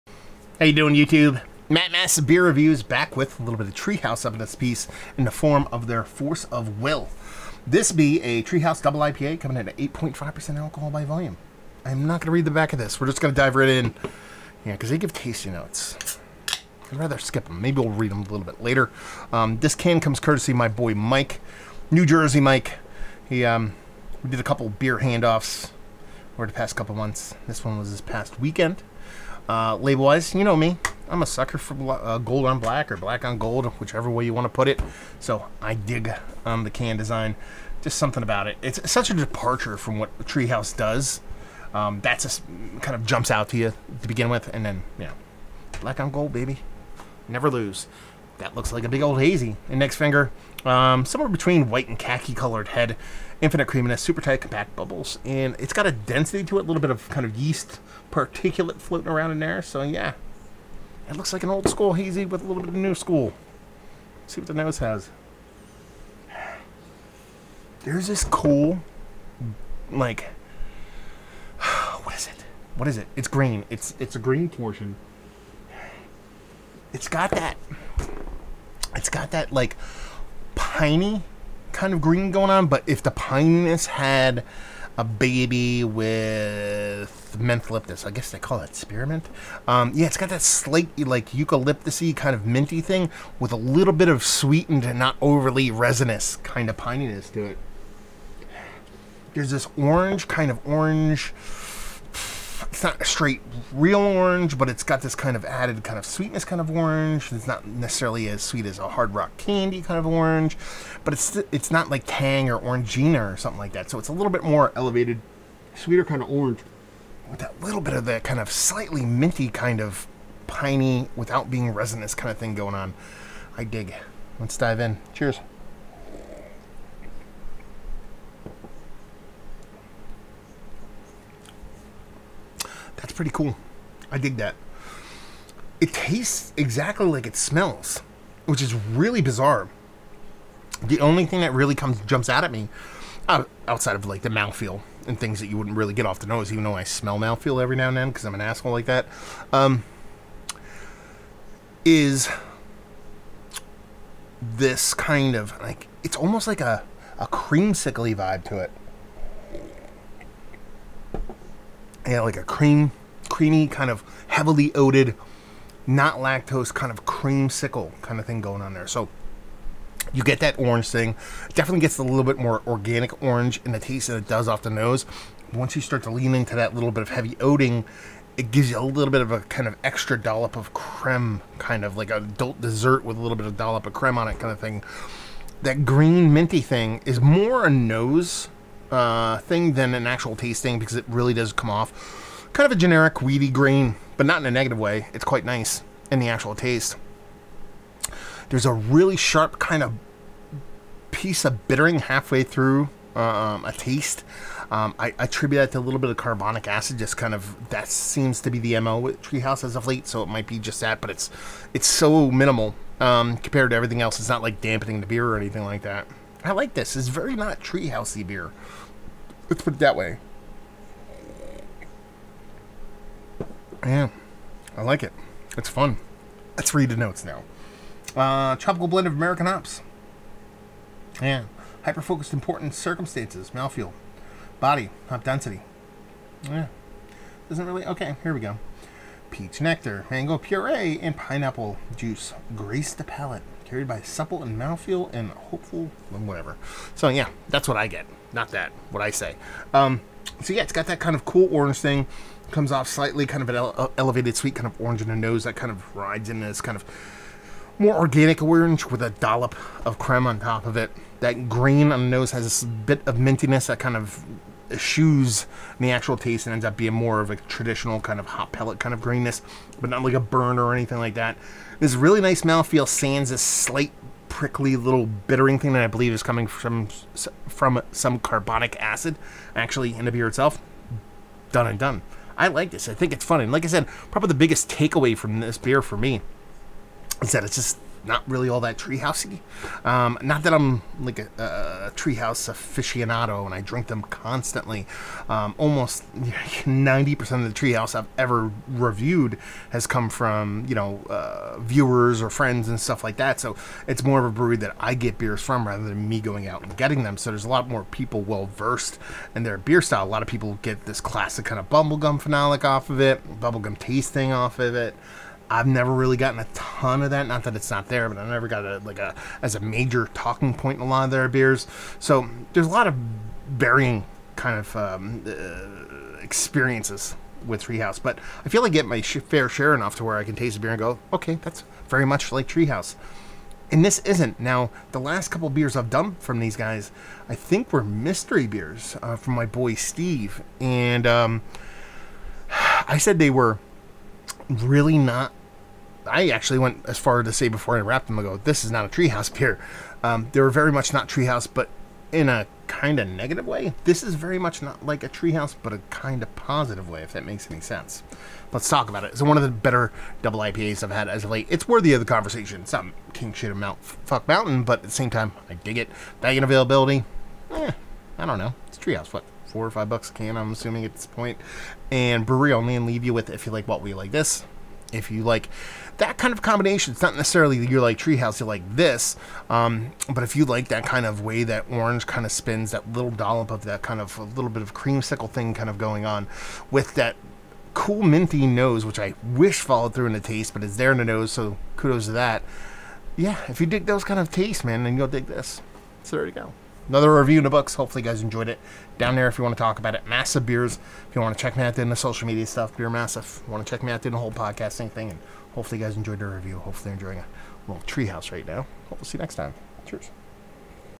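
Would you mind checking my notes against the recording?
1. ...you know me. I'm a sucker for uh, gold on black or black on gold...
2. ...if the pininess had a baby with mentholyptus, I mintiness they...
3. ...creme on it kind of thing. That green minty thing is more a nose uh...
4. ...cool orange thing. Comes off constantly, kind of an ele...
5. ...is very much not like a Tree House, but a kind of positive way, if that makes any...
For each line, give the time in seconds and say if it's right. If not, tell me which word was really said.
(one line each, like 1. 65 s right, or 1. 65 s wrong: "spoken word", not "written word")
1. 30 s right
2. 82 s wrong: "guess", not "mintiness"
3. 183 s right
4. 251 s wrong: "slightly", not "constantly"
5. 354 s right.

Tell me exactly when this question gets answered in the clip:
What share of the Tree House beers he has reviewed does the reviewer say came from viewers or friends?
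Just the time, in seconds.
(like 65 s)
296 s.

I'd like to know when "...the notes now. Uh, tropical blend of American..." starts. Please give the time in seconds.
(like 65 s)
226 s.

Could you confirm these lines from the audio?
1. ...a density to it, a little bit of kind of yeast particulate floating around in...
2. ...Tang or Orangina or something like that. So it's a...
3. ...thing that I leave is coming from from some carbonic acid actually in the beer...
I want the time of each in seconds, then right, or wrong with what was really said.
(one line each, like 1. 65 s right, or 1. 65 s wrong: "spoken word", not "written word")
1. 55 s right
2. 112 s right
3. 275 s wrong: "believe", not "leave".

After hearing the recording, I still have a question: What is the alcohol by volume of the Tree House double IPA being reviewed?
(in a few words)
8.5%.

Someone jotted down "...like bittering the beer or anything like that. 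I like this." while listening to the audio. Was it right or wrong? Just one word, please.
wrong.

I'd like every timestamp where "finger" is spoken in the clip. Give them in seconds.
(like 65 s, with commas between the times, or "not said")
49 s.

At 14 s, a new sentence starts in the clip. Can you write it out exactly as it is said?
Yeah, because they give tasting notes.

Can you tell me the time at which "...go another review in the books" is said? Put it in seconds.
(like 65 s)
396 s.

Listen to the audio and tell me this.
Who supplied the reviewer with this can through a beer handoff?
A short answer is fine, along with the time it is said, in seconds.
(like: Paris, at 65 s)
New Jersey Mike, at 21 s.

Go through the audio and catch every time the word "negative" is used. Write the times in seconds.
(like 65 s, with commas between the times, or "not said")
194 s, 353 s.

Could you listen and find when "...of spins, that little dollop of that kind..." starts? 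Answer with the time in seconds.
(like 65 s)
382 s.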